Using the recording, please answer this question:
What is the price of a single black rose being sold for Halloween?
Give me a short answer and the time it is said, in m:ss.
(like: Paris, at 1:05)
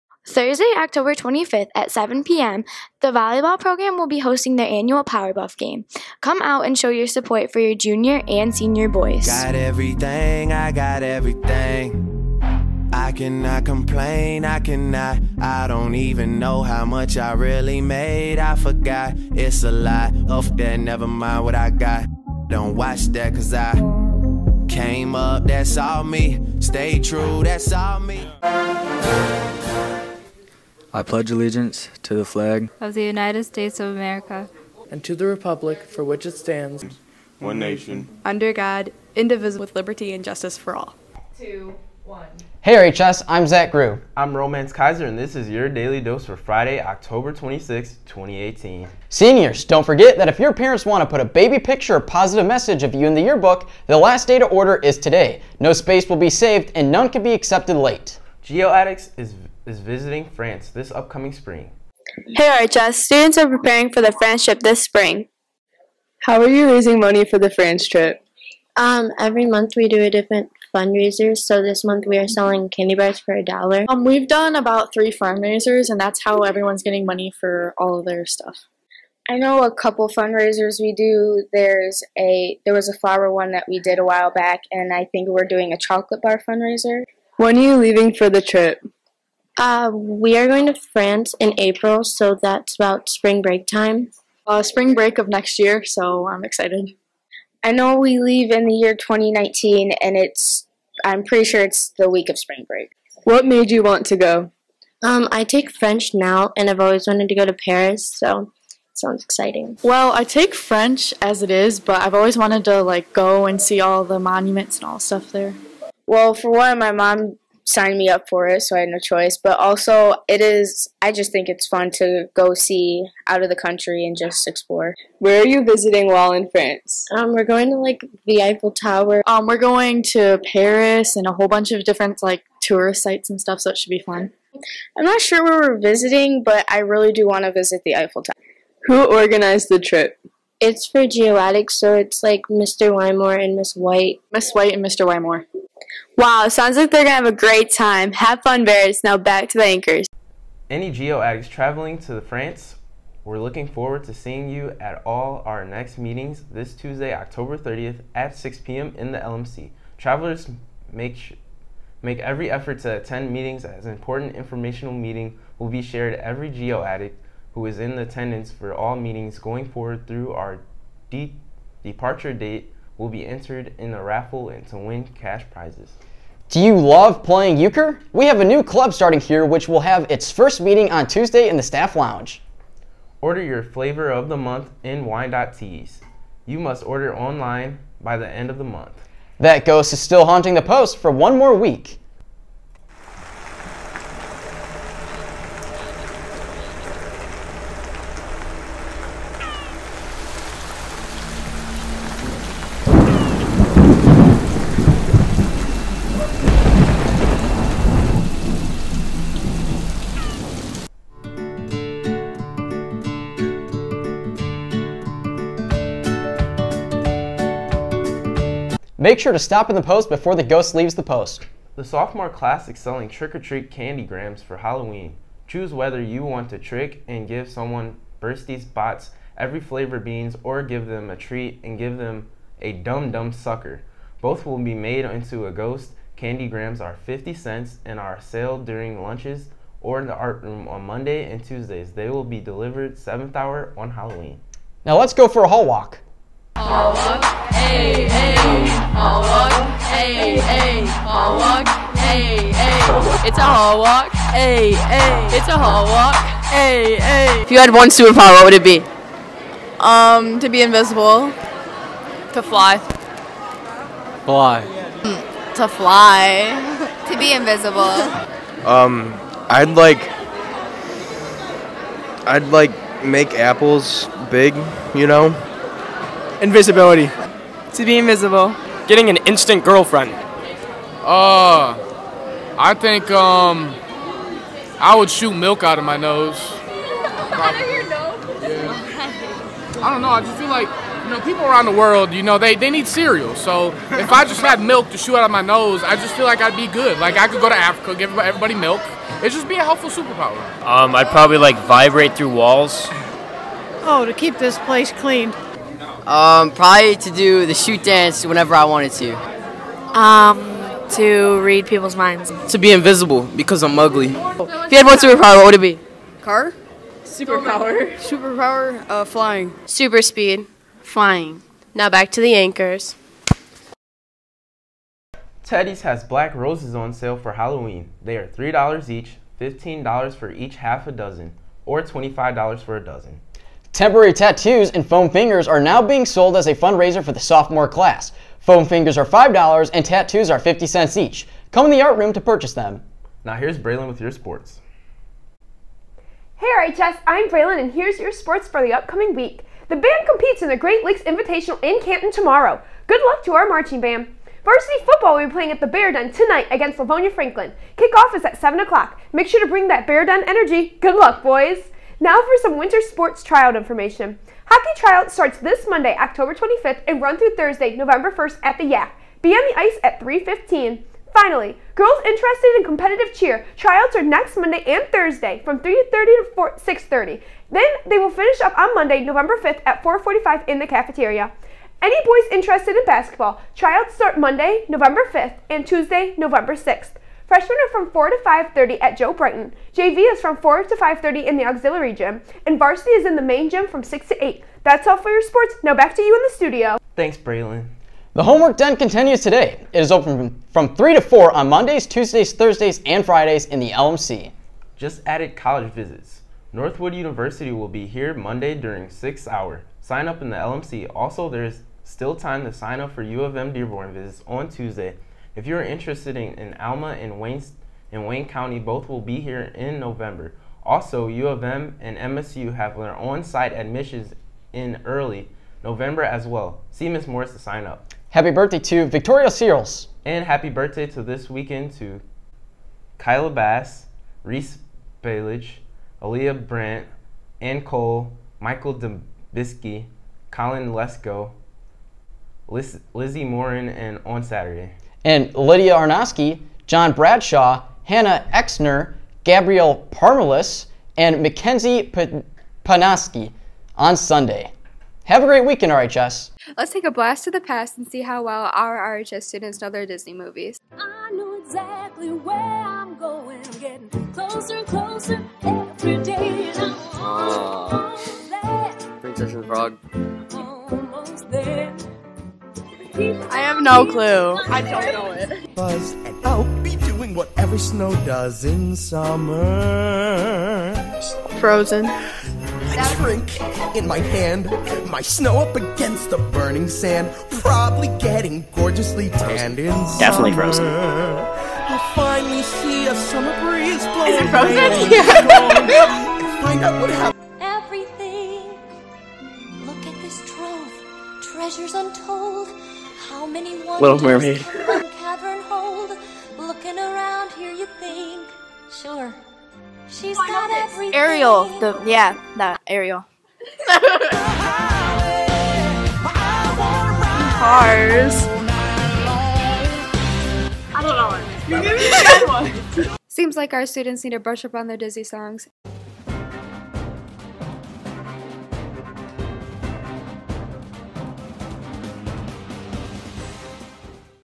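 $3, at 5:28.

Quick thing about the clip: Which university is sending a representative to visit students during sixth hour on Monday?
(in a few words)
Northwood University.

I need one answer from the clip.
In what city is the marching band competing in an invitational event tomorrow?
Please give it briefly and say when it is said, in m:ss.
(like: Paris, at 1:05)
Canton, at 5:51.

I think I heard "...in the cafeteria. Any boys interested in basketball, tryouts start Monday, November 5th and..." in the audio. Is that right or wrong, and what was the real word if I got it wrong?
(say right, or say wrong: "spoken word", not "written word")
right.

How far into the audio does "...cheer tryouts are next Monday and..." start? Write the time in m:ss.
6:13.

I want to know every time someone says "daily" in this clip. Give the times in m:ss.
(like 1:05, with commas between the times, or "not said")
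0:45.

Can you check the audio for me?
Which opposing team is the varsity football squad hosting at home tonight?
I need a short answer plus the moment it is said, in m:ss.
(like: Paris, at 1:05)
Livonia Franklin, at 5:56.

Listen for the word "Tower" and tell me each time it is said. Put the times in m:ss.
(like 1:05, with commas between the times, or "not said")
2:08, 2:18.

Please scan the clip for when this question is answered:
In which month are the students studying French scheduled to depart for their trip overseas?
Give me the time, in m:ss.
1:31.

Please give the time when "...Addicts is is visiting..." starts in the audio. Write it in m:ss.
0:58.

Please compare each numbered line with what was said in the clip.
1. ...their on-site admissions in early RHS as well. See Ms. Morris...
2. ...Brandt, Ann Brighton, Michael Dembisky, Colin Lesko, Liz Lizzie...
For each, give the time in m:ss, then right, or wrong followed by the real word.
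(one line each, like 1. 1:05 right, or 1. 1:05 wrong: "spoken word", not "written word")
1. 7:02 wrong: "November", not "RHS"
2. 7:16 wrong: "Cole", not "Brighton".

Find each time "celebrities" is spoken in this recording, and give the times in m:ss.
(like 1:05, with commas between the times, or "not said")
not said.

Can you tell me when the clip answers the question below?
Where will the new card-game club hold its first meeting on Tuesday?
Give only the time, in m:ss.
3:01.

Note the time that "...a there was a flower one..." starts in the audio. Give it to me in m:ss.
1:22.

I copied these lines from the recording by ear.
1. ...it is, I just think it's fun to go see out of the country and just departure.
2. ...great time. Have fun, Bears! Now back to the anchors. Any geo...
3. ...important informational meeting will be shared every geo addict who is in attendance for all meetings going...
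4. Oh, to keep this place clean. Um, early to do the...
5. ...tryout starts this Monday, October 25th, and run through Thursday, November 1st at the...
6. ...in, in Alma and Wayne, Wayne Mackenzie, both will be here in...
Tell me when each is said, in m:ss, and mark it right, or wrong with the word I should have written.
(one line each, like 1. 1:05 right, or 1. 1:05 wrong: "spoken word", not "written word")
1. 2:00 wrong: "explore", not "departure"
2. 2:27 right
3. 2:43 right
4. 5:03 wrong: "probably", not "early"
5. 6:04 right
6. 6:56 wrong: "County", not "Mackenzie".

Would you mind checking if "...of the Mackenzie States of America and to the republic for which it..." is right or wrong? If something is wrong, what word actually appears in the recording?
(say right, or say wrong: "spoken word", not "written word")
wrong: "United", not "Mackenzie".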